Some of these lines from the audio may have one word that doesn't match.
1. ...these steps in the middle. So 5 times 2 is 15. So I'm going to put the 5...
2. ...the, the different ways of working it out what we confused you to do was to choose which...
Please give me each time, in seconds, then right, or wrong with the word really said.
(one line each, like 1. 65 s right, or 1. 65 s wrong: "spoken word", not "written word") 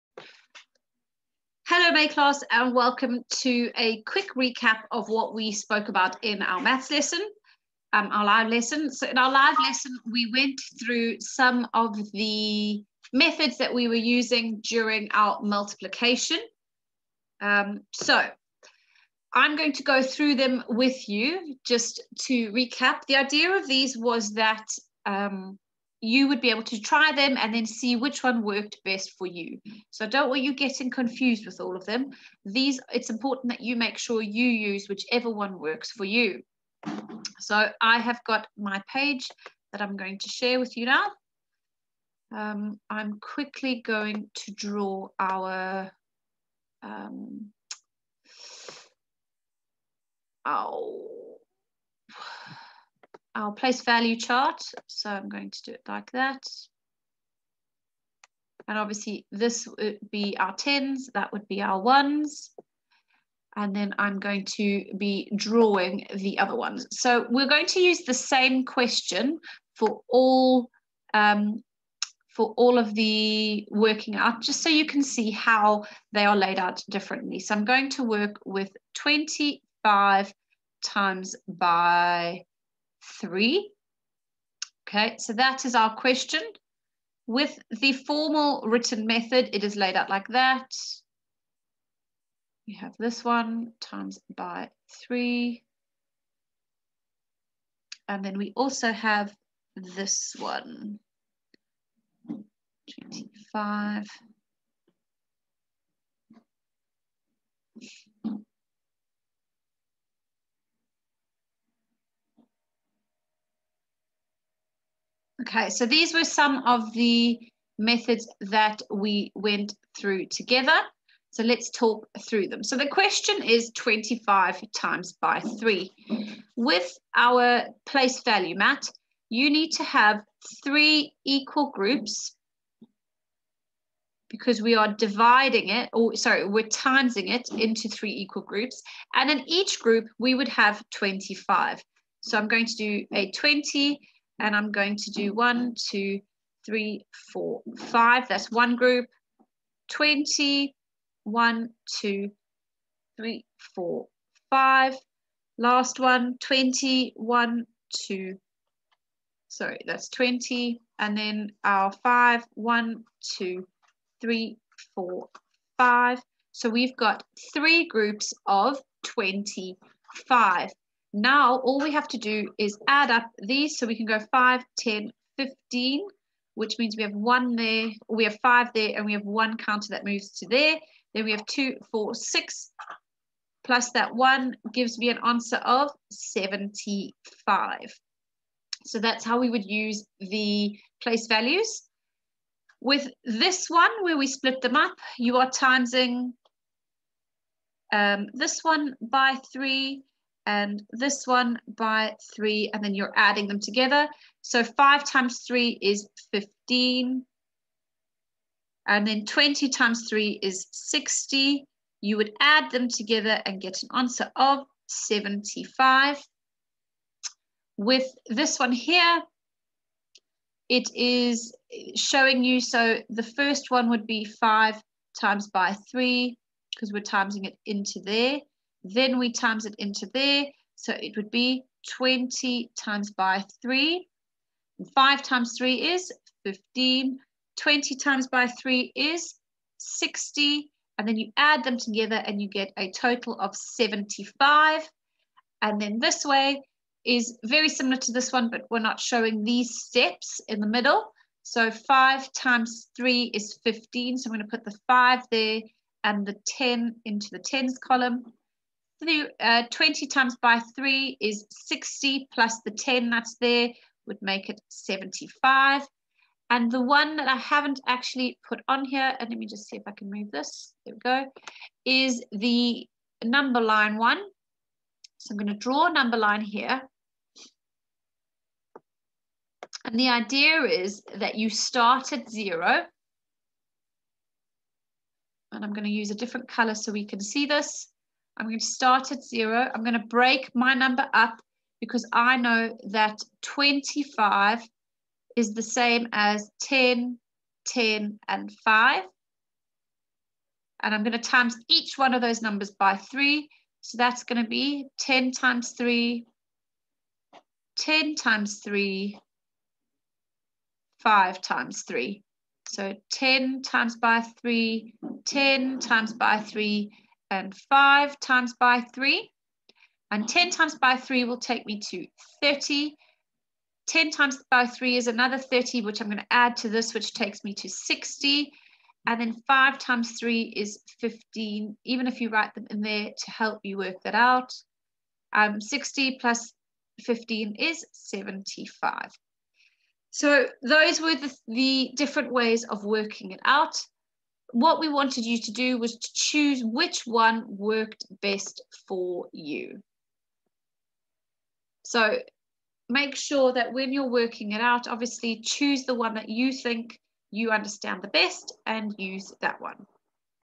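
1. 249 s wrong: "3", not "2"
2. 341 s wrong: "wanted", not "confused".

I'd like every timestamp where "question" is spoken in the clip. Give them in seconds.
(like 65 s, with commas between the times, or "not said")
68 s, 85 s, 122 s.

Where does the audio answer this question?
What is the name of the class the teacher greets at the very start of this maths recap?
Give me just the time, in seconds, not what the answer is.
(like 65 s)
1 s.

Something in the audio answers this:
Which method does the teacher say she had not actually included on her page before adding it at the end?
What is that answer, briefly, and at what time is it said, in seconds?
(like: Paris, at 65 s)
The number line, at 272 s.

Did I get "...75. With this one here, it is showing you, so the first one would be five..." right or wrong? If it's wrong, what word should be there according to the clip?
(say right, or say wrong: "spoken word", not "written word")
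right.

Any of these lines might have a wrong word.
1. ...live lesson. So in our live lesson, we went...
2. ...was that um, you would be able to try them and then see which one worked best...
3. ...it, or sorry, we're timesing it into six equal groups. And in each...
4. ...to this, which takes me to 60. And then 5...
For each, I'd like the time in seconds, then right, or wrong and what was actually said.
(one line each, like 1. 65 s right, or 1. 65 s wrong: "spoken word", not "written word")
1. 8 s right
2. 23 s right
3. 135 s wrong: "three", not "six"
4. 326 s right.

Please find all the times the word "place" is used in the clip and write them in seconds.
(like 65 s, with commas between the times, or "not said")
53 s, 127 s, 191 s.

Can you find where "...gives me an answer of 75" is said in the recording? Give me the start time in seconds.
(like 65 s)
184 s.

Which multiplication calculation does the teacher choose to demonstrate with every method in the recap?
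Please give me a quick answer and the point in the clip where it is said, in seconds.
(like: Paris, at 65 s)
25 times 3, at 78 s.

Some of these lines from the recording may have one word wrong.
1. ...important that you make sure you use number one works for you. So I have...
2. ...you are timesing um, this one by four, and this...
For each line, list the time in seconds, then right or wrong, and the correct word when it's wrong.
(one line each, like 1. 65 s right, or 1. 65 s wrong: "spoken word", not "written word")
1. 33 s wrong: "whichever", not "number"
2. 195 s wrong: "three", not "four".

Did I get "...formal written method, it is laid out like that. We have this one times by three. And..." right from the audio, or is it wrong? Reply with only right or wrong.
right.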